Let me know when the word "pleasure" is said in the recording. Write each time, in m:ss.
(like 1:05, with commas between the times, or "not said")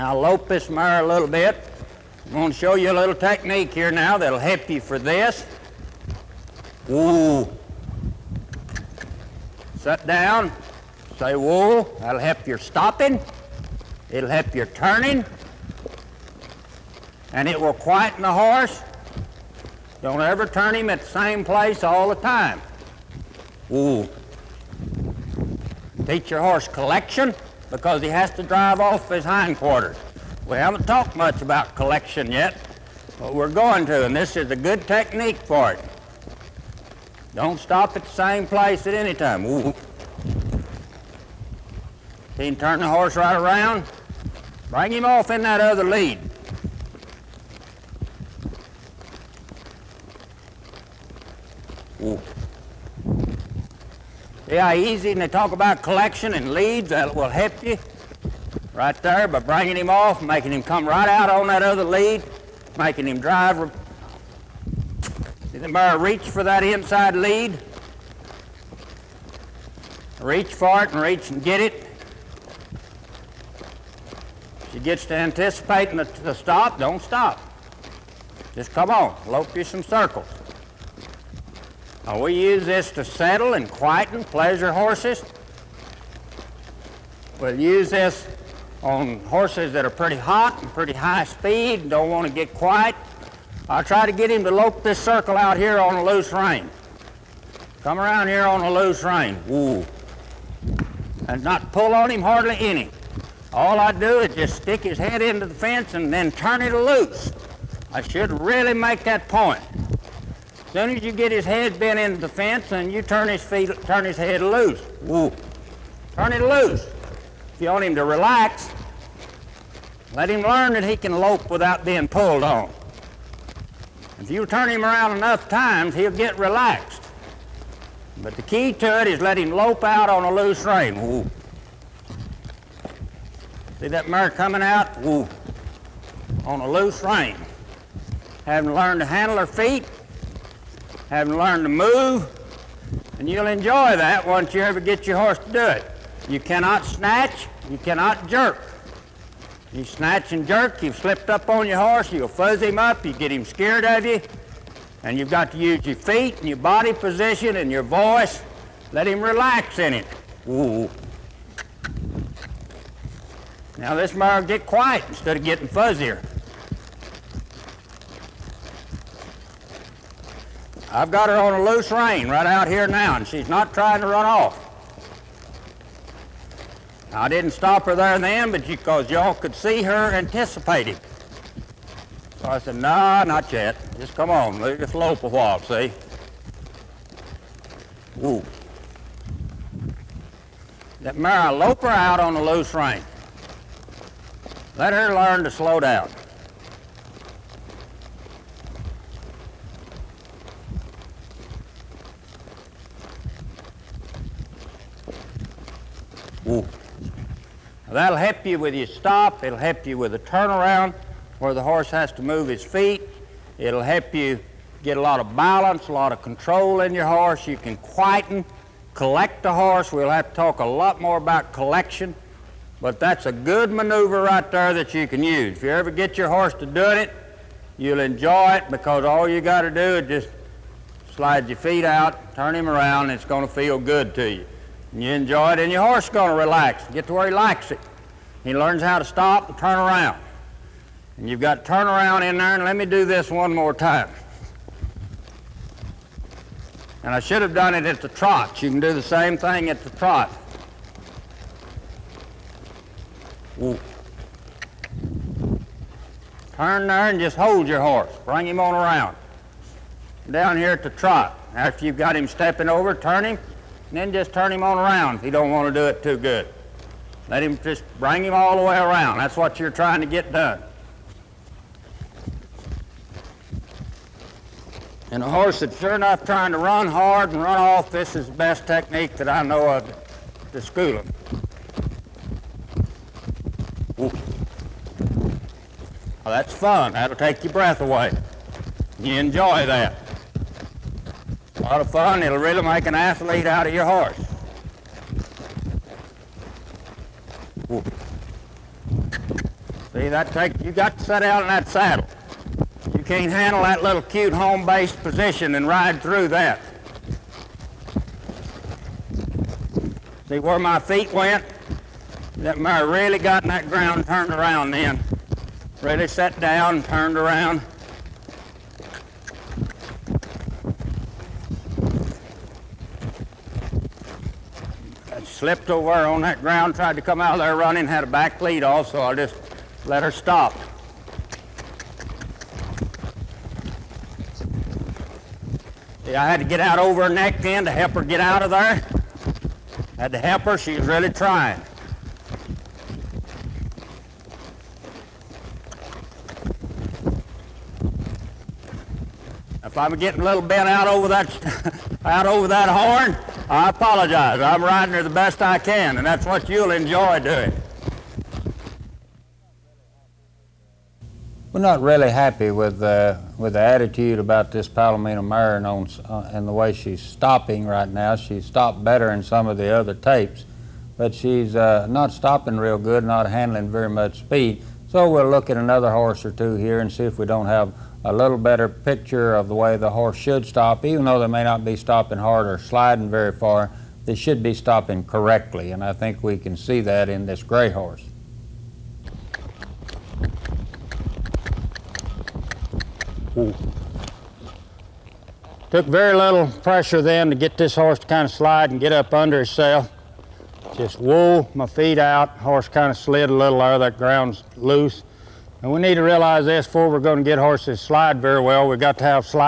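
1:24.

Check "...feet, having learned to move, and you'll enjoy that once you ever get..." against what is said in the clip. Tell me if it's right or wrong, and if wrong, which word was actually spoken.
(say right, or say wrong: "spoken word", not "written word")
right.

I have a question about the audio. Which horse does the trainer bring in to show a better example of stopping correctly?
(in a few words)
gray horse.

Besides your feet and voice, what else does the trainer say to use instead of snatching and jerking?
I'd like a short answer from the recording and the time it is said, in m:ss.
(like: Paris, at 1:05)
body position, at 2:36.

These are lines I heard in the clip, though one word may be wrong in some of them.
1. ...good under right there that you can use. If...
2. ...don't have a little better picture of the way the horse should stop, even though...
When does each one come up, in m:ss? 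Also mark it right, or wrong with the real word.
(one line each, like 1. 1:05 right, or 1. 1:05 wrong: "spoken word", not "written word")
1. 3:43 wrong: "maneuver", not "under"
2. 6:17 right.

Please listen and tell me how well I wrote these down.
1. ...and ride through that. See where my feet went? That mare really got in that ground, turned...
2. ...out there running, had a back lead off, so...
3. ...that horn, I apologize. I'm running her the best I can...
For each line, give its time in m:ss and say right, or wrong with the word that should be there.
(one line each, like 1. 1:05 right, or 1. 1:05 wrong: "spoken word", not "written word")
1. 5:05 right
2. 5:27 right
3. 5:52 wrong: "riding", not "running".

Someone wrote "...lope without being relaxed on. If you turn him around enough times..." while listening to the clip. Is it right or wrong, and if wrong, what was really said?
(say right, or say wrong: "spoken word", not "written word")
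wrong: "pulled", not "relaxed".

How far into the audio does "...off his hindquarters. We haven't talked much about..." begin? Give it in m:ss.
0:28.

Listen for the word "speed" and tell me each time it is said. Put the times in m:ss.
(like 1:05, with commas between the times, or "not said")
1:31, 6:14.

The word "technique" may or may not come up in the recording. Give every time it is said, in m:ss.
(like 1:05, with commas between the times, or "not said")
0:03, 0:34, 4:38.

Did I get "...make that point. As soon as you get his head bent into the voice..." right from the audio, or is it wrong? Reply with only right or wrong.
wrong.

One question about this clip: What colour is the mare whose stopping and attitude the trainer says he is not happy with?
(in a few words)
Palomino.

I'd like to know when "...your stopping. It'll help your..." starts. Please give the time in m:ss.
0:12.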